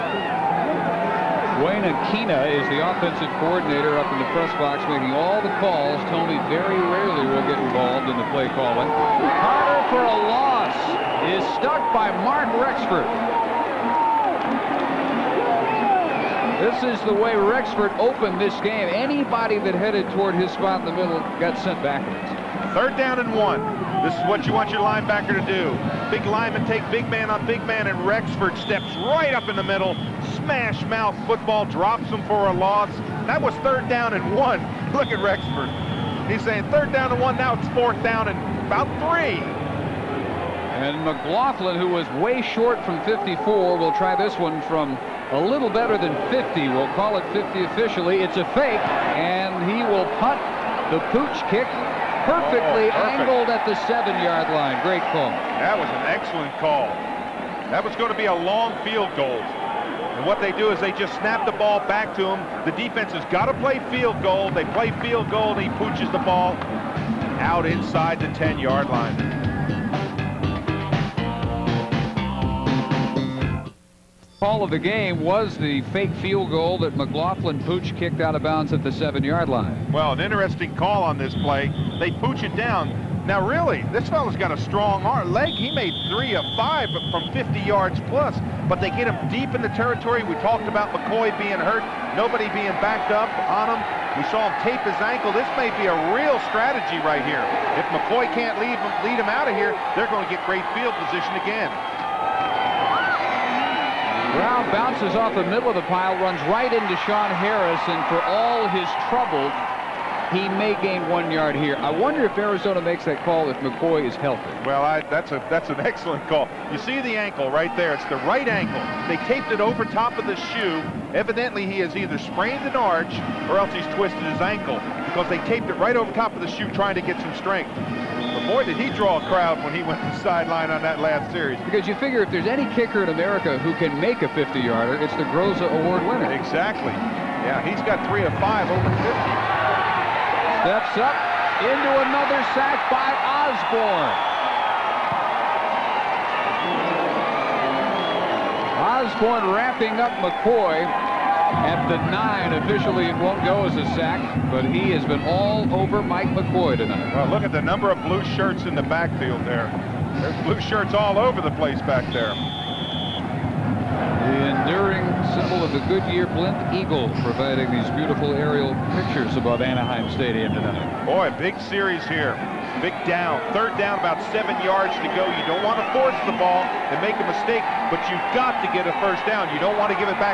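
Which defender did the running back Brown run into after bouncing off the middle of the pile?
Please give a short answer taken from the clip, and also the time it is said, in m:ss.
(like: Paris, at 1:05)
Sean Harris, at 1:47.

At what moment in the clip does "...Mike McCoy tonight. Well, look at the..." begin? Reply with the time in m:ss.
2:36.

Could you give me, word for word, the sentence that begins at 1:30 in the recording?
We talked about McCoy being hurt, nobody being backed up on him.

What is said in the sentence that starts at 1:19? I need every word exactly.
Well, an interesting call on this play.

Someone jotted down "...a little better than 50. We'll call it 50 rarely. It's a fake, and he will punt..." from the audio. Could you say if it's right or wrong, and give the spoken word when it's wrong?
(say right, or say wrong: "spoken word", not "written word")
wrong: "officially", not "rarely".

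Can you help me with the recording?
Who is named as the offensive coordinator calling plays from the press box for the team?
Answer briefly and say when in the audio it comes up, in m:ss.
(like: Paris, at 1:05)
Duane Akina, at 0:01.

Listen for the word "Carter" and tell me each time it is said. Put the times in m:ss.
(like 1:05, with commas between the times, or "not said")
0:08.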